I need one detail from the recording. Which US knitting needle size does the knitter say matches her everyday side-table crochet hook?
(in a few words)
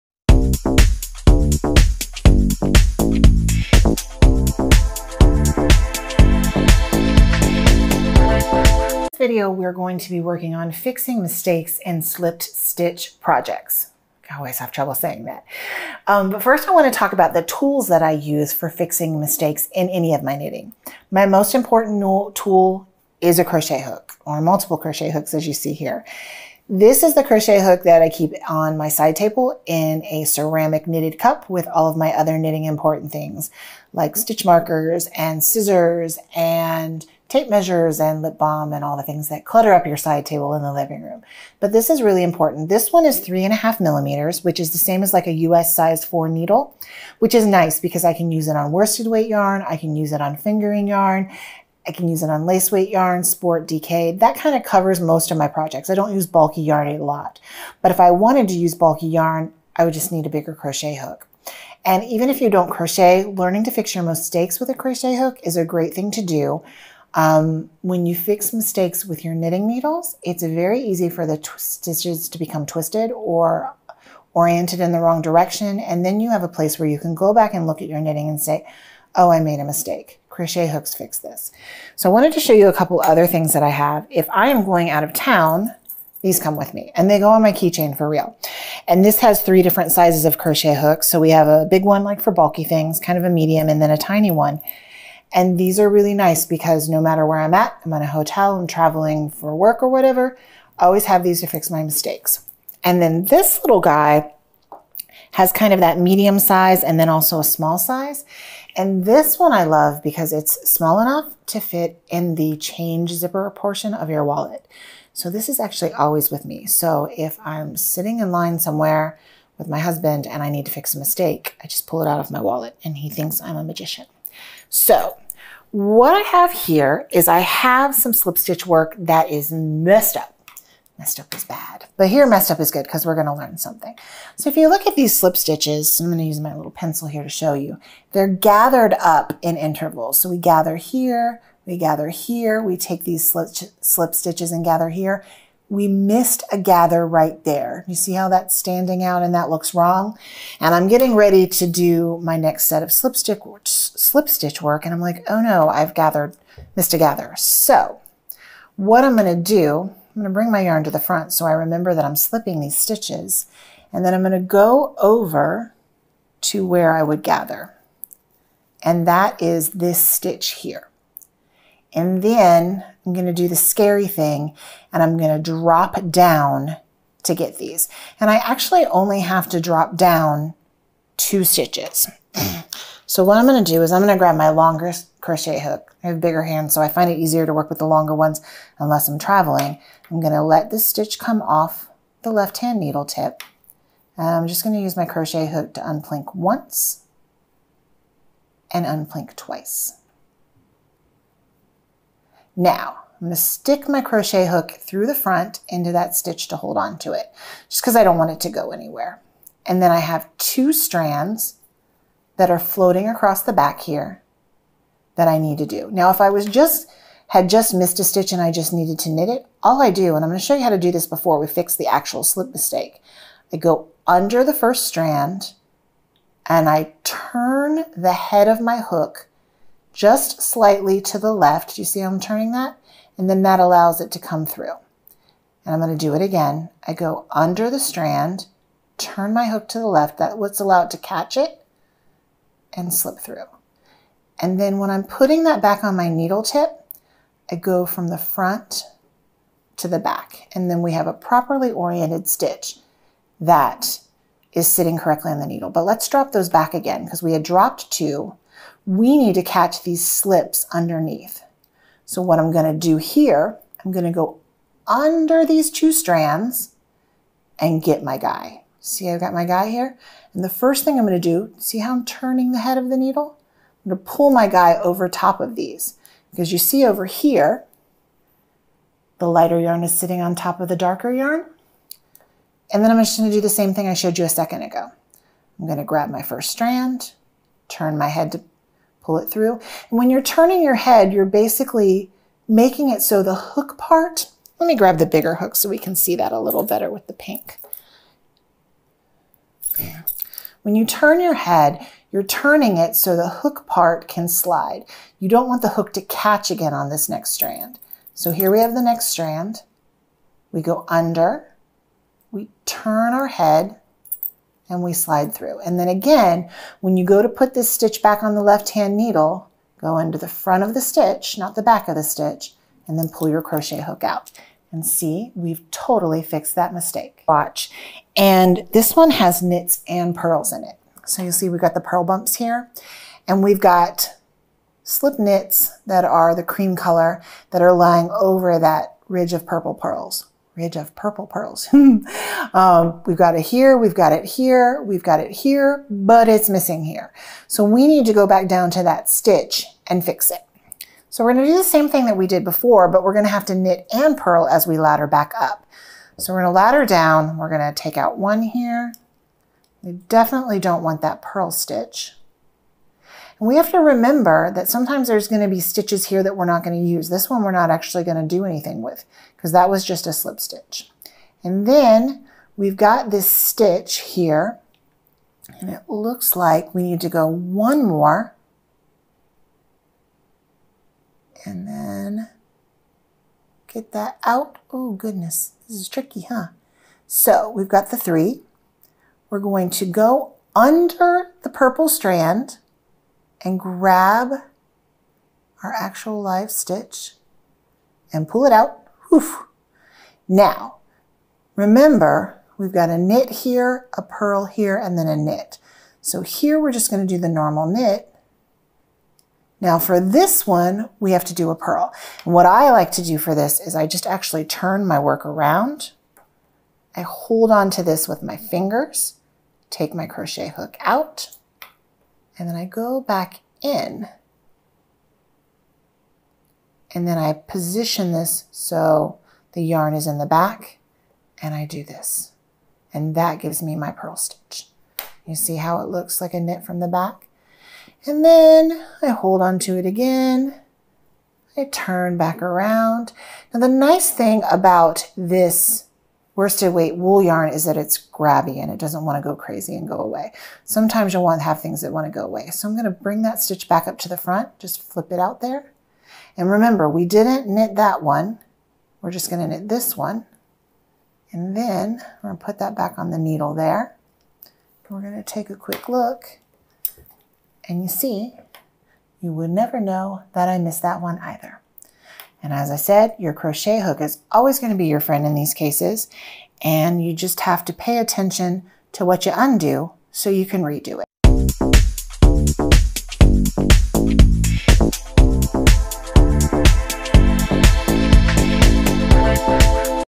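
US size 4.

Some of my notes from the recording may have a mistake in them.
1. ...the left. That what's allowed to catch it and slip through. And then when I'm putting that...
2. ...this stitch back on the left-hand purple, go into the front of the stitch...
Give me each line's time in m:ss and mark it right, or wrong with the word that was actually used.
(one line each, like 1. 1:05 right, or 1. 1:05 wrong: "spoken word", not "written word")
1. 3:59 right
2. 5:17 wrong: "needle", not "purple".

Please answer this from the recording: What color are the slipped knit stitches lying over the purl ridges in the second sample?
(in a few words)
cream.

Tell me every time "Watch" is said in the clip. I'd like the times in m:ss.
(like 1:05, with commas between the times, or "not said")
5:27.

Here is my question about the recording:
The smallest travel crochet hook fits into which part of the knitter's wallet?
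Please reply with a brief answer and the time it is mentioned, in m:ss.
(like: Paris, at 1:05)
change zipper portion, at 1:52.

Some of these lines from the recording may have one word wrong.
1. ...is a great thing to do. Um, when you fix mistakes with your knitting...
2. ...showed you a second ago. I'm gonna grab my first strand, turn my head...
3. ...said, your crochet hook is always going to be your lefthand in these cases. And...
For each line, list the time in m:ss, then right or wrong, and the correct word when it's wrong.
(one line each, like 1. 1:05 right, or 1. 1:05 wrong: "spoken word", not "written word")
1. 1:05 right
2. 4:43 right
3. 7:52 wrong: "friend", not "lefthand".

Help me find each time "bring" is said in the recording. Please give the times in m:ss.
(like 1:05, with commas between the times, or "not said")
2:40, 7:32.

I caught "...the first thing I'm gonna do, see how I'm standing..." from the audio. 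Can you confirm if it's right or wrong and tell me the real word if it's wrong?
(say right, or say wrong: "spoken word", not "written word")
wrong: "turning", not "standing".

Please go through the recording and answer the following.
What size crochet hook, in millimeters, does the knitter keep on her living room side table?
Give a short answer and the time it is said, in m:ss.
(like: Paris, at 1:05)
3.5 millimeters, at 0:43.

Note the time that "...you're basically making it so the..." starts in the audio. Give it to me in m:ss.
4:51.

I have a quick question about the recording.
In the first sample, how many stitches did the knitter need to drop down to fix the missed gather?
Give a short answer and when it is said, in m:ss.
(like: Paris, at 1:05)
2, at 3:01.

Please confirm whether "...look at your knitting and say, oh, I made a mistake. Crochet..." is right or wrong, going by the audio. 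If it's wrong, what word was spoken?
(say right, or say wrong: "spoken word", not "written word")
right.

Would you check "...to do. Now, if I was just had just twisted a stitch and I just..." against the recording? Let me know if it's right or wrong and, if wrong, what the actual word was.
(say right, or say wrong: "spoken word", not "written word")
wrong: "missed", not "twisted".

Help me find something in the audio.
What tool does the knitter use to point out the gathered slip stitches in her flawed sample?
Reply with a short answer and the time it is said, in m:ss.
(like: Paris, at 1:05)
pencil, at 2:16.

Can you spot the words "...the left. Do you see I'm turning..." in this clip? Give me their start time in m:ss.
3:51.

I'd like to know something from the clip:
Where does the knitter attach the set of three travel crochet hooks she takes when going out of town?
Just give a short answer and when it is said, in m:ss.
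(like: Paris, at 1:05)
keychain, at 1:27.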